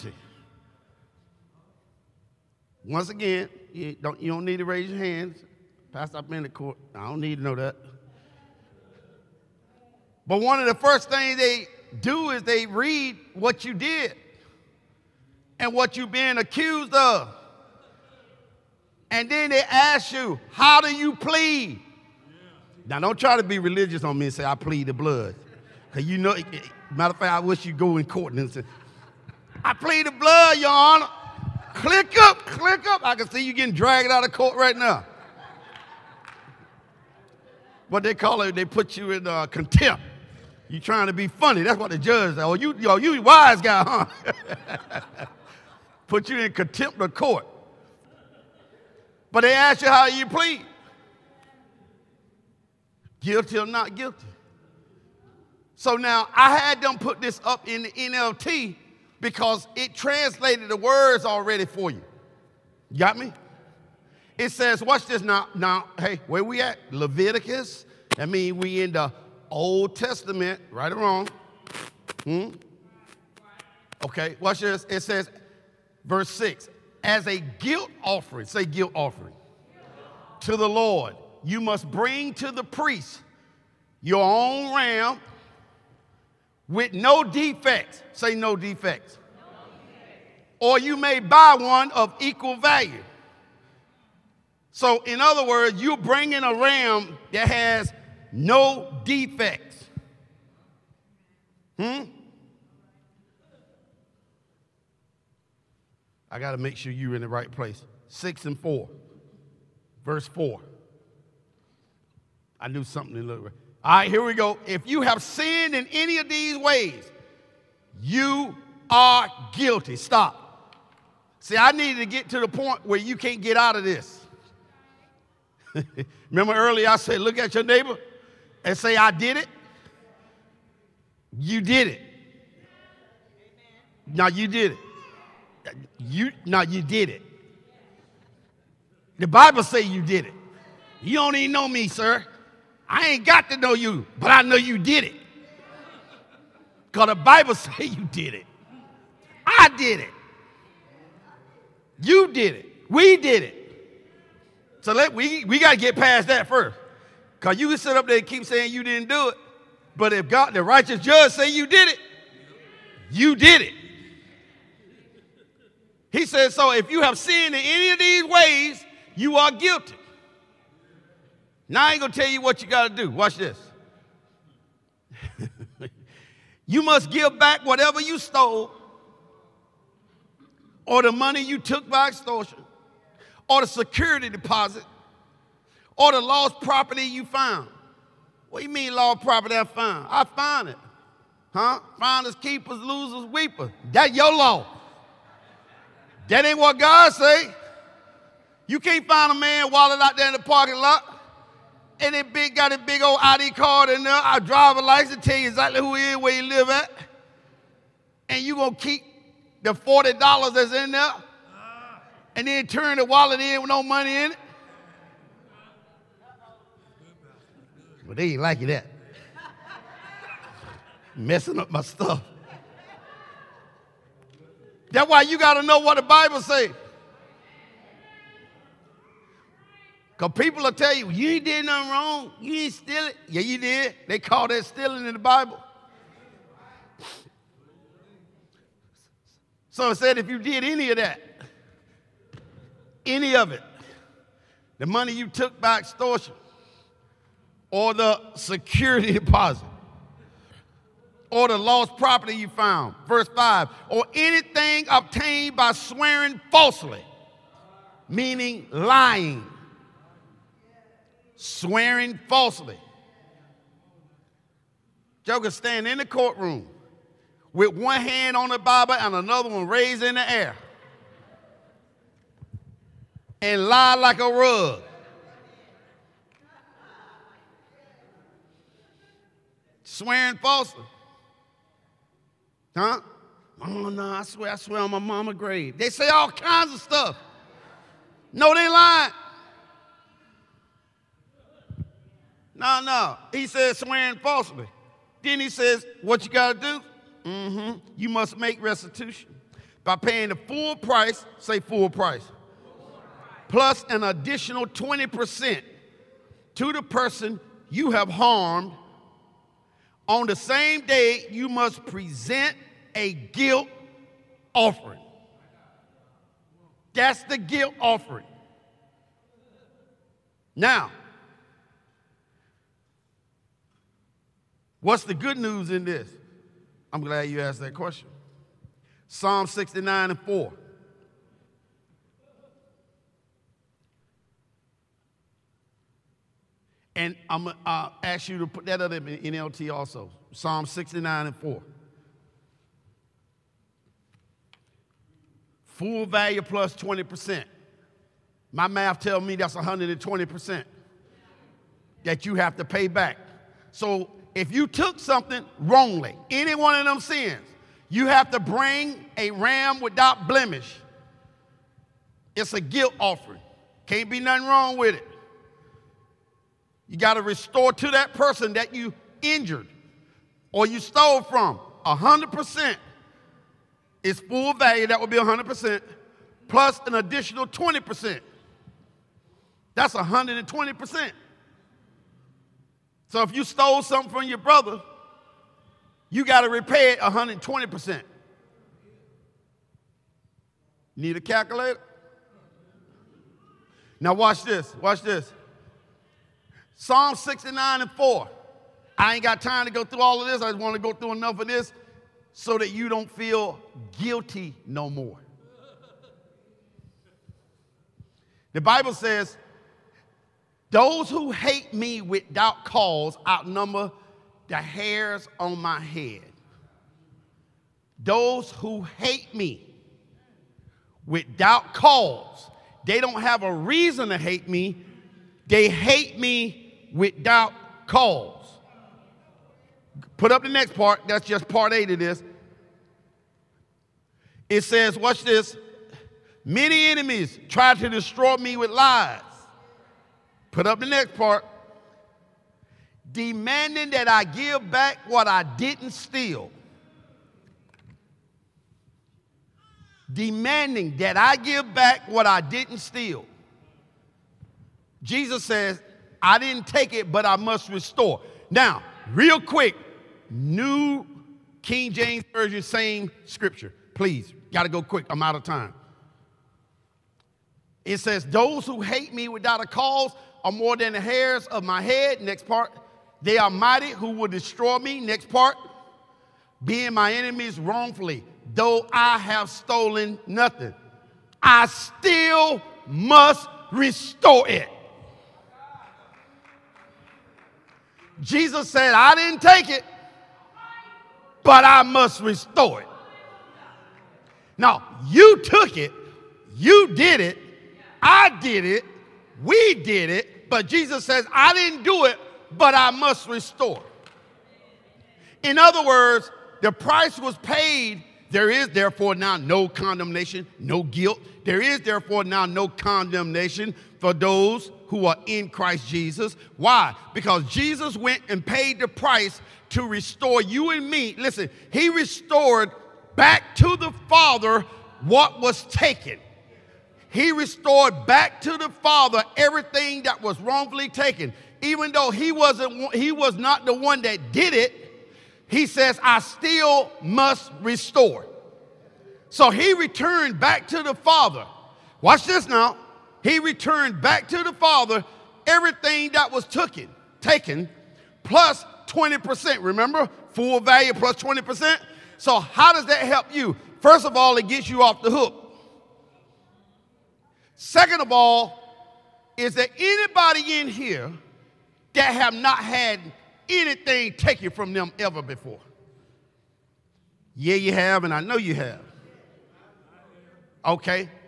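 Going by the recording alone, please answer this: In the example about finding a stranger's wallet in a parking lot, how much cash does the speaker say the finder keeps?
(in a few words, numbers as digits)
$40.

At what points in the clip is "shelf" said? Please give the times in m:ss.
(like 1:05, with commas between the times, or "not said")
not said.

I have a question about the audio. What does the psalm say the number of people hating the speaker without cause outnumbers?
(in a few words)
the hairs on my head.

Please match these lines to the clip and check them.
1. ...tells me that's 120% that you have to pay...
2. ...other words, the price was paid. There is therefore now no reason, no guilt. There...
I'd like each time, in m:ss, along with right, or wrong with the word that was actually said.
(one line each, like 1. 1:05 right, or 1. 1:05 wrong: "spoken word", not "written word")
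1. 5:48 right
2. 8:25 wrong: "condemnation", not "reason".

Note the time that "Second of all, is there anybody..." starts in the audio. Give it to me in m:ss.
9:17.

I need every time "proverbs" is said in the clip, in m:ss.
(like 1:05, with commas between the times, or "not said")
not said.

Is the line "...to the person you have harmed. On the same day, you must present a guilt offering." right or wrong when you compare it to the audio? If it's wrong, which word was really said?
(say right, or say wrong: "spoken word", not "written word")
right.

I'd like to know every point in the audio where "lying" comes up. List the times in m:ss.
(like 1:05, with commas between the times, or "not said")
4:18, 4:48.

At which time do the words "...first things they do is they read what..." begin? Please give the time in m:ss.
0:10.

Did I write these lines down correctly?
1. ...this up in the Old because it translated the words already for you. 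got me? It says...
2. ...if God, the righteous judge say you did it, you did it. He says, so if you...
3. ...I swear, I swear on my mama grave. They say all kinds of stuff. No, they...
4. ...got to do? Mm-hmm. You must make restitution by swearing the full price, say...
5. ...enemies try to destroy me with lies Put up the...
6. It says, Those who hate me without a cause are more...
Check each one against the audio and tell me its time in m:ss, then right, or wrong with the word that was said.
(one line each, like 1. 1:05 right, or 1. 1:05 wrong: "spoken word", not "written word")
1. 0:57 wrong: "NLT", not "Old"
2. 2:40 right
3. 4:44 right
4. 4:56 wrong: "paying", not "swearing"
5. 7:16 right
6. 7:47 right.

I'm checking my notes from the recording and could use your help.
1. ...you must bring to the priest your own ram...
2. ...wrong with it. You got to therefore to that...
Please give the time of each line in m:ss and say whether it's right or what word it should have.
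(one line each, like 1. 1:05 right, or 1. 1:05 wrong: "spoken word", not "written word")
1. 1:21 right
2. 6:04 wrong: "restore", not "therefore".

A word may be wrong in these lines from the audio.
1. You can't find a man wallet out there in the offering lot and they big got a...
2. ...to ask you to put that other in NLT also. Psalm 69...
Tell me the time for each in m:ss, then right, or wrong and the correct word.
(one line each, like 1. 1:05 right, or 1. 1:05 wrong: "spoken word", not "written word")
1. 3:18 wrong: "parking", not "offering"
2. 5:37 right.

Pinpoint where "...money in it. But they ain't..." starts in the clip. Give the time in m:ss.
3:33.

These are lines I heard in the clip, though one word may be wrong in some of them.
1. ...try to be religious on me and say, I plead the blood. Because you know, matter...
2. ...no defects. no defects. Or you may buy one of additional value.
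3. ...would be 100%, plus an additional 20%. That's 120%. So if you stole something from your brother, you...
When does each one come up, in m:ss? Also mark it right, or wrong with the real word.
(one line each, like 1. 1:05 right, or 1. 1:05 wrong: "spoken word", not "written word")
1. 0:23 right
2. 1:28 wrong: "equal", not "additional"
3. 6:14 right.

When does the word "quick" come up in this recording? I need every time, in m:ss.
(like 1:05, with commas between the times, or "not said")
7:39, 7:44.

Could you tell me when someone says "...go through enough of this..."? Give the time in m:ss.
6:40.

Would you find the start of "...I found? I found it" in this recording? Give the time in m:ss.
3:09.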